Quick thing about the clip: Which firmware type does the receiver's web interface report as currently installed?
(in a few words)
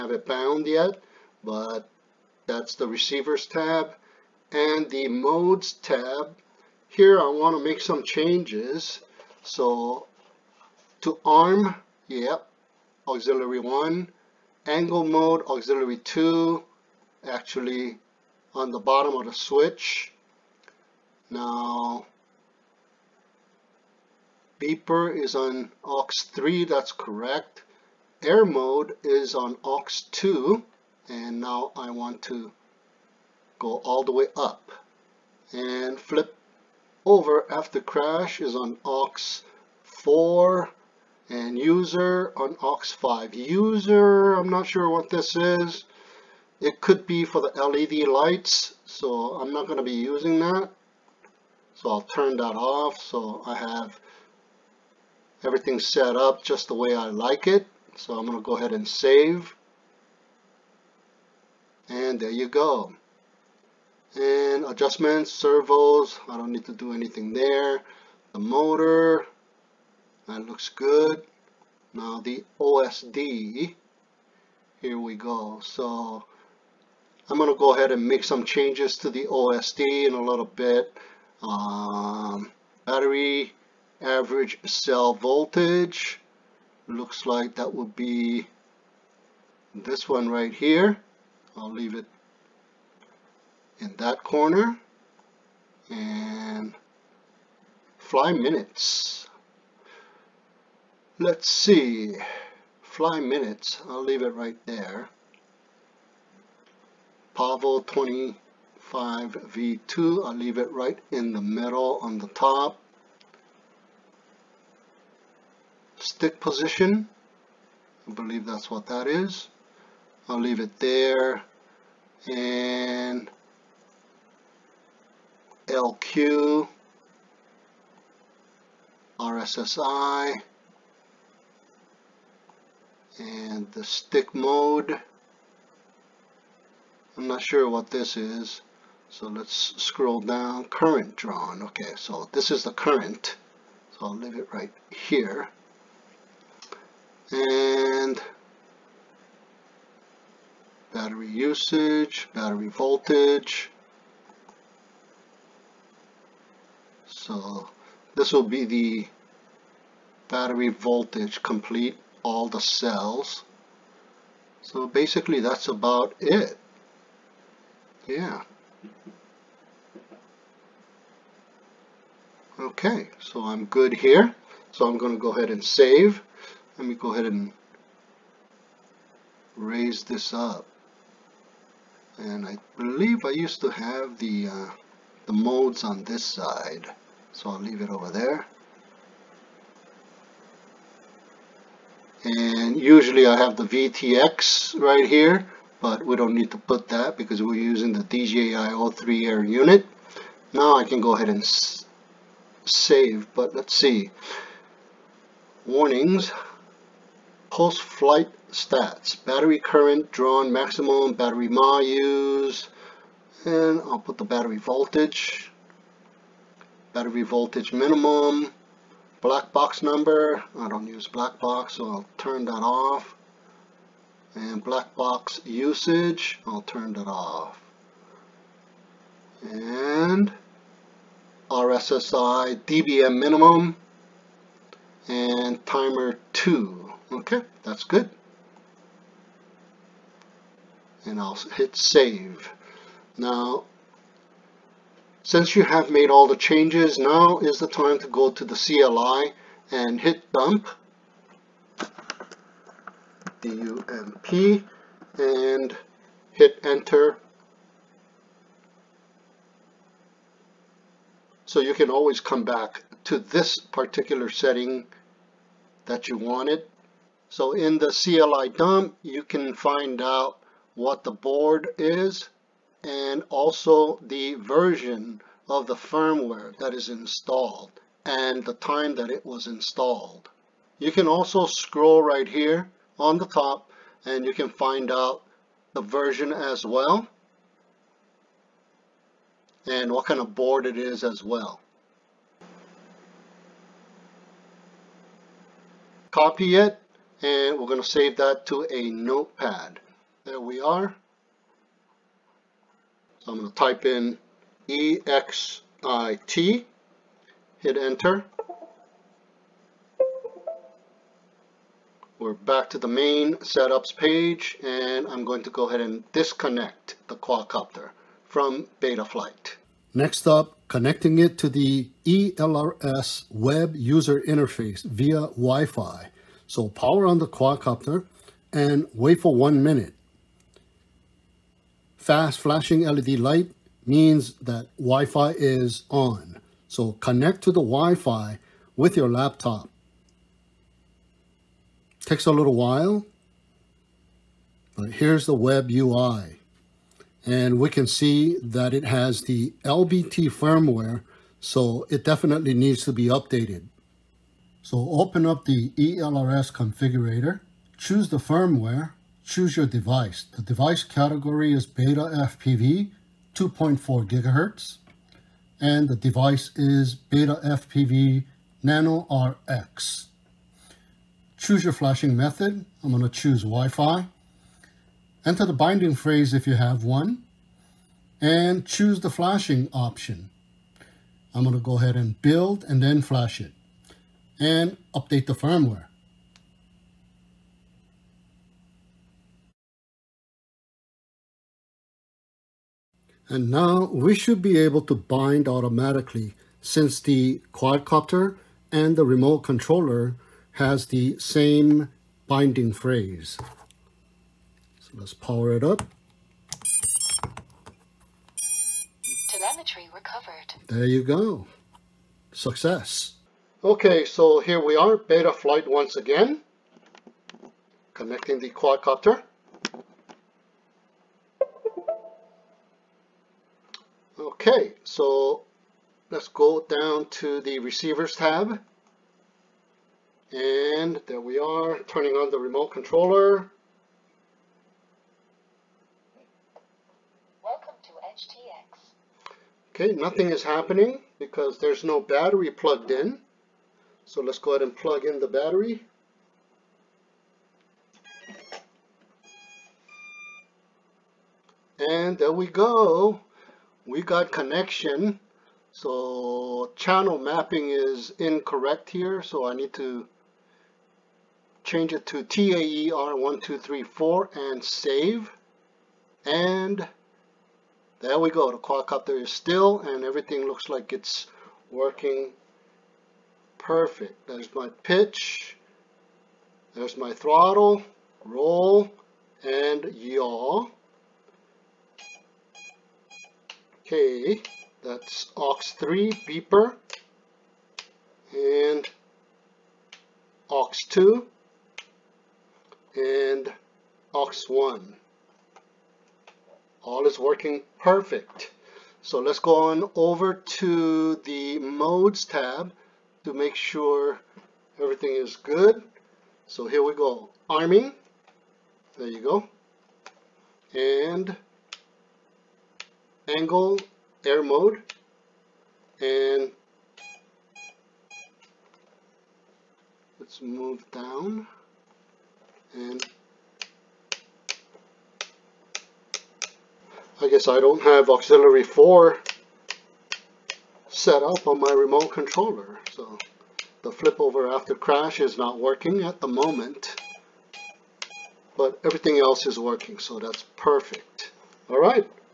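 LBT.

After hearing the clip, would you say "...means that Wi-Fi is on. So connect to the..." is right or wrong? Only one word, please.
right.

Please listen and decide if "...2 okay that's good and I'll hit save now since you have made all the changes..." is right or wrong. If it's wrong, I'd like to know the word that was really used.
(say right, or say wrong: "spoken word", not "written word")
right.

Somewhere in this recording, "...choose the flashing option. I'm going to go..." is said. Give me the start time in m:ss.
6:18.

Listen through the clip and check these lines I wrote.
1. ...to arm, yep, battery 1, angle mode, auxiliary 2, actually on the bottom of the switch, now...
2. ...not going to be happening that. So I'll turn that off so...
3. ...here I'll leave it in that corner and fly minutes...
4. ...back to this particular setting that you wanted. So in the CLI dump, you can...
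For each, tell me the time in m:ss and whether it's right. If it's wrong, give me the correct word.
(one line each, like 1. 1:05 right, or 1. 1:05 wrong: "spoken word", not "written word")
1. 0:11 wrong: "auxiliary", not "battery"
2. 0:49 wrong: "using", not "happening"
3. 1:30 right
4. 4:22 right.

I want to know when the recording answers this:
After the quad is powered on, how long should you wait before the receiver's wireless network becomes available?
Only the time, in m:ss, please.
5:29.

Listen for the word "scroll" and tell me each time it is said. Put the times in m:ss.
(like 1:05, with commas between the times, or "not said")
2:19, 4:41.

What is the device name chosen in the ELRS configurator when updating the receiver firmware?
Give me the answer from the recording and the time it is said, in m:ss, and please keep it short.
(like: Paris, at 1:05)
Beta FPV Nano RX, at 6:06.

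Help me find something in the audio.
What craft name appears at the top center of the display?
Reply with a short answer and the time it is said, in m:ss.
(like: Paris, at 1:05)
Pavo 20 5V2, at 1:47.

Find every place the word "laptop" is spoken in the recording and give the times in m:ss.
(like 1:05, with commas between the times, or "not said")
5:39.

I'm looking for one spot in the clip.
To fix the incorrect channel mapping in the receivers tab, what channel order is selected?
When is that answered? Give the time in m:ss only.
7:42.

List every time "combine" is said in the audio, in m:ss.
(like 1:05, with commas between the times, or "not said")
not said.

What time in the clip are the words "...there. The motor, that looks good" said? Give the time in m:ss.
1:07.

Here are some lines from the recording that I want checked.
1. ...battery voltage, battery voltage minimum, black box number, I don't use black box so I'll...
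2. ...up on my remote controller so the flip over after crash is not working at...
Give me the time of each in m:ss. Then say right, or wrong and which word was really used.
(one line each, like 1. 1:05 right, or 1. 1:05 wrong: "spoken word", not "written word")
1. 3:34 right
2. 8:51 right.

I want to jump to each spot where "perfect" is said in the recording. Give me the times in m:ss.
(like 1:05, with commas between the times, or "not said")
7:53, 8:17, 9:00.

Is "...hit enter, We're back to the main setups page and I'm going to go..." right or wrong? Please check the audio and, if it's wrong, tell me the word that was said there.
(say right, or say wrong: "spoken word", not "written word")
right.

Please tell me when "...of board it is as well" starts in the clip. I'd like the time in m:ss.
4:50.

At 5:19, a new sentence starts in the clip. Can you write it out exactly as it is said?
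Next up, connecting it to the ELRS web user interface via Wi-Fi.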